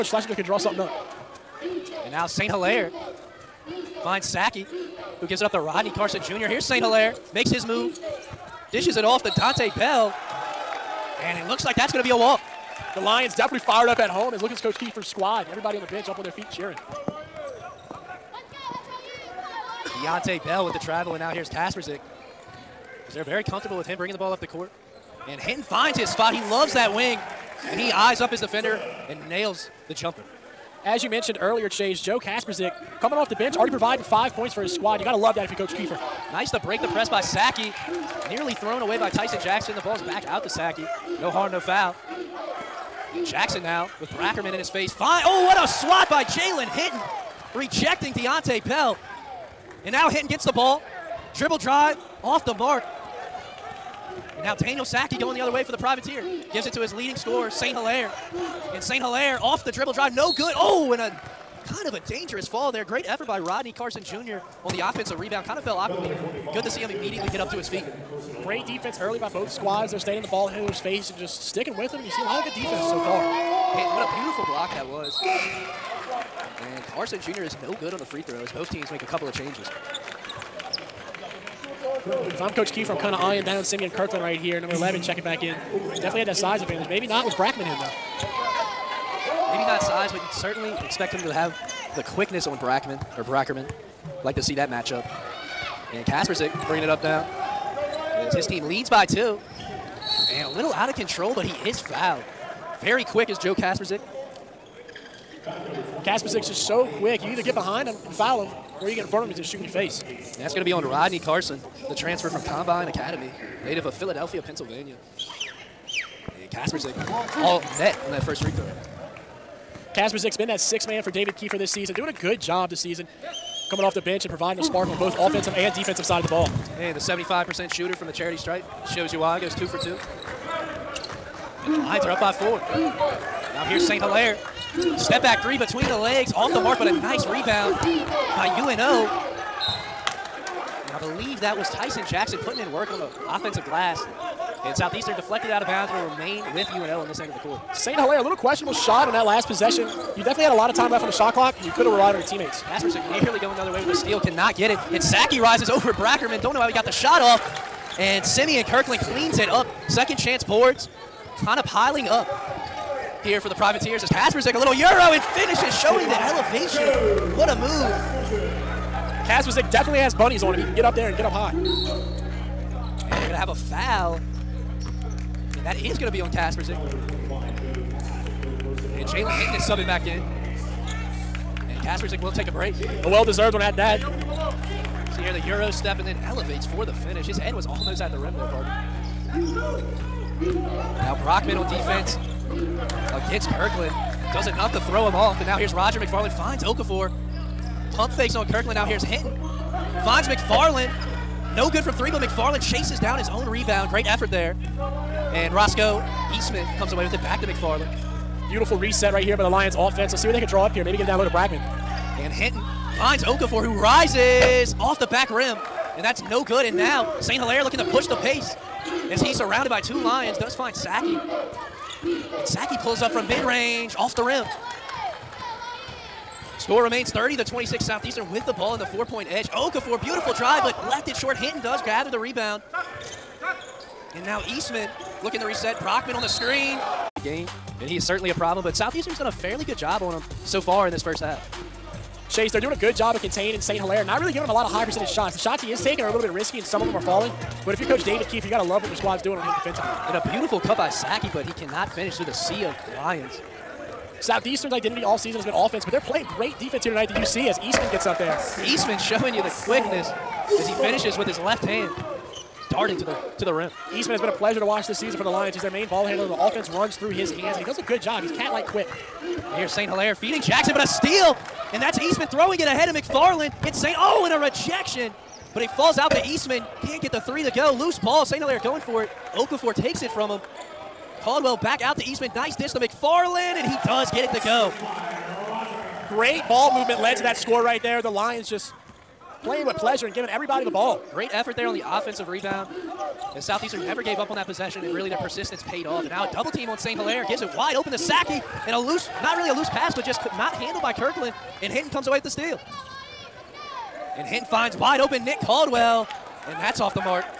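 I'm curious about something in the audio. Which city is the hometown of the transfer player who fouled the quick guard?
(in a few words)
Philadelphia.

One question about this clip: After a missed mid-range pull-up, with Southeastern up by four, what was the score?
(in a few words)
30 to 26.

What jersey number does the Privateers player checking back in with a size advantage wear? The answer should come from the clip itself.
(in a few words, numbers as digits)
11.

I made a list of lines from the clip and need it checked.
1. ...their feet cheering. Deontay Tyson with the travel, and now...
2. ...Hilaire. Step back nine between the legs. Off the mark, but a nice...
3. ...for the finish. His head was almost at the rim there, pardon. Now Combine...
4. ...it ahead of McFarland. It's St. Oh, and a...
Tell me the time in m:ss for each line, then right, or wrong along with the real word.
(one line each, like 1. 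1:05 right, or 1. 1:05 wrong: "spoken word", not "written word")
1. 0:16 wrong: "Bell", not "Tyson"
2. 2:14 wrong: "three", not "nine"
3. 3:06 wrong: "Brockman", not "Combine"
4. 4:32 right.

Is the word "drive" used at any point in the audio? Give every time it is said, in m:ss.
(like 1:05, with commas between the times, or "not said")
0:51, 0:59, 3:50.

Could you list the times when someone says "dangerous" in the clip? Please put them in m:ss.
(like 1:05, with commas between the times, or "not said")
1:02.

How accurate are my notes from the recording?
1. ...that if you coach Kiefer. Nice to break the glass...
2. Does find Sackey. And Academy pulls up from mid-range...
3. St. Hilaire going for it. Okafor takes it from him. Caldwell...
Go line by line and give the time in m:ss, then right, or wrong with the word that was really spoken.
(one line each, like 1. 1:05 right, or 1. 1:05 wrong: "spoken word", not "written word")
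1. 0:35 wrong: "press", not "glass"
2. 3:40 wrong: "Sackey", not "Academy"
3. 4:38 right.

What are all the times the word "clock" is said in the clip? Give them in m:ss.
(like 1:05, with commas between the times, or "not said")
2:31.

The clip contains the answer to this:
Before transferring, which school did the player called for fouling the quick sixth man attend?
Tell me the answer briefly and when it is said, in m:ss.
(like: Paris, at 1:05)
Combine Academy, at 1:52.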